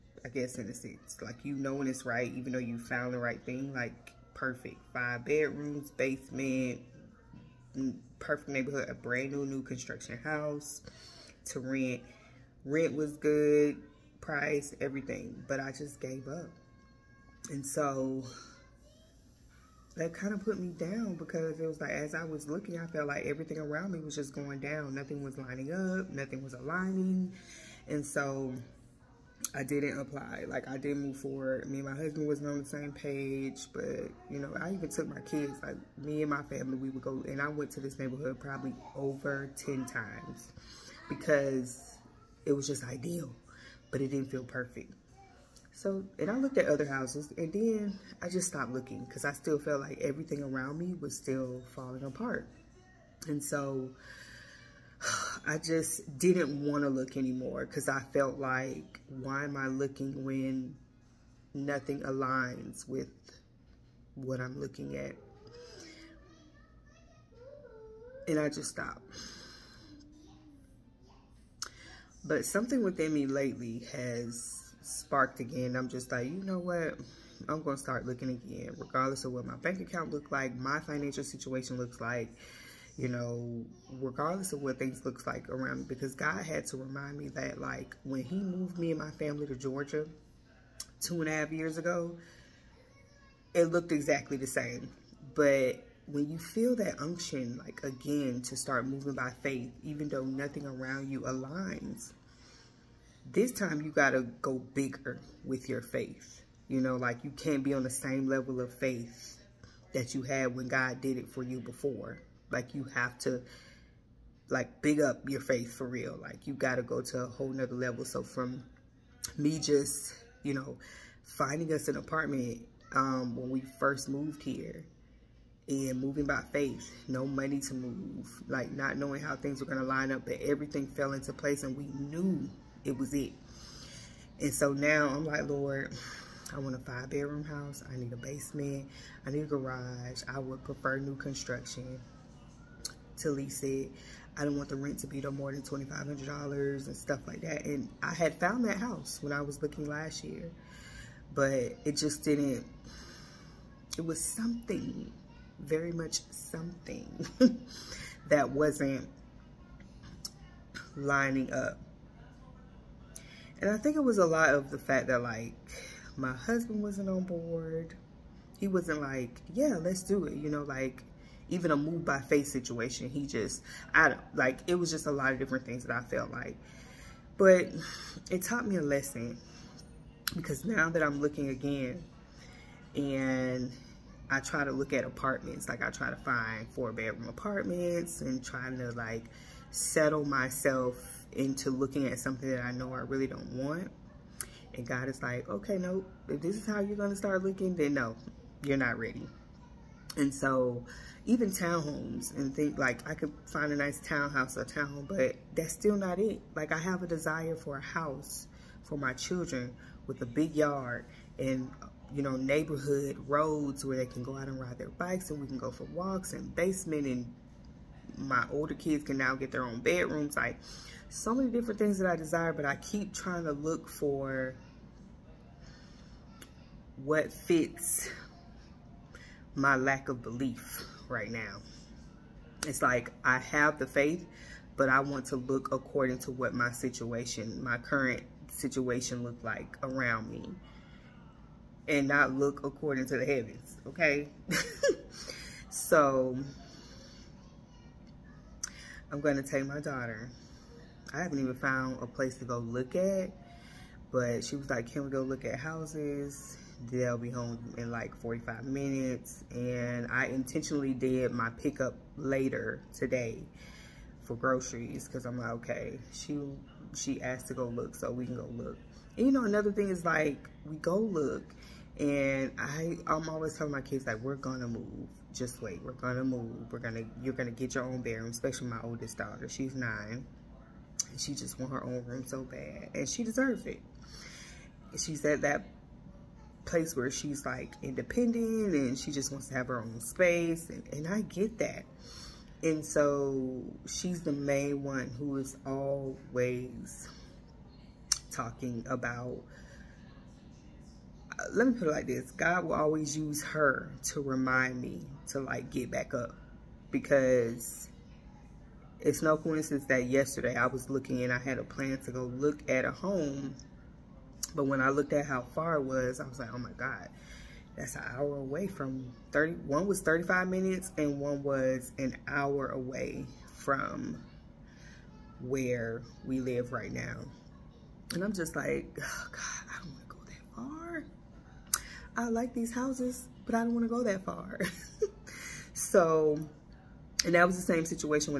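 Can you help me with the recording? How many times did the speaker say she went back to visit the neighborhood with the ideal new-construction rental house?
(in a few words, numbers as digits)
over 10.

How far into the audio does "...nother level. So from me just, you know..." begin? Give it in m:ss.
1:57.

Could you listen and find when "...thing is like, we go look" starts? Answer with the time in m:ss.
4:29.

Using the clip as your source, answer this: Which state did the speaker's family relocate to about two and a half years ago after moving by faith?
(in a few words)
Georgia.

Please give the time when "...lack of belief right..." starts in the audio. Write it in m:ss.
3:49.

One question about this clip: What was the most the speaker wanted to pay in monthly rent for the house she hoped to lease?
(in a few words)
$2,500.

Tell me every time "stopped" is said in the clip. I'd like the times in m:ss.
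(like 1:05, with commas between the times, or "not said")
0:48, 1:08.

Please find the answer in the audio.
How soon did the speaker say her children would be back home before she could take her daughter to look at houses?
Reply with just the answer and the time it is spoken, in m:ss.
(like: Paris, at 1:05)
45 minutes, at 4:18.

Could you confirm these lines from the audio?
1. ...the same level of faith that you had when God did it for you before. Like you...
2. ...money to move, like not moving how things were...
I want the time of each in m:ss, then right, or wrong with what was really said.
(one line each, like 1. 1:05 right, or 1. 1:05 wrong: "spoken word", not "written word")
1. 1:47 right
2. 2:07 wrong: "knowing", not "moving".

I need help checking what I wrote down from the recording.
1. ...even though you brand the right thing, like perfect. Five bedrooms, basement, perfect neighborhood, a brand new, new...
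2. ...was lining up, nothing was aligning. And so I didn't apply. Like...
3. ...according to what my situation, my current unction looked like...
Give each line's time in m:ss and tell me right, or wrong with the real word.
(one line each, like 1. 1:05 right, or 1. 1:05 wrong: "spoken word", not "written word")
1. 0:02 wrong: "found", not "brand"
2. 0:25 right
3. 3:55 wrong: "situation", not "unction".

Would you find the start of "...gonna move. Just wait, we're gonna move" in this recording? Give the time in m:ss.
4:34.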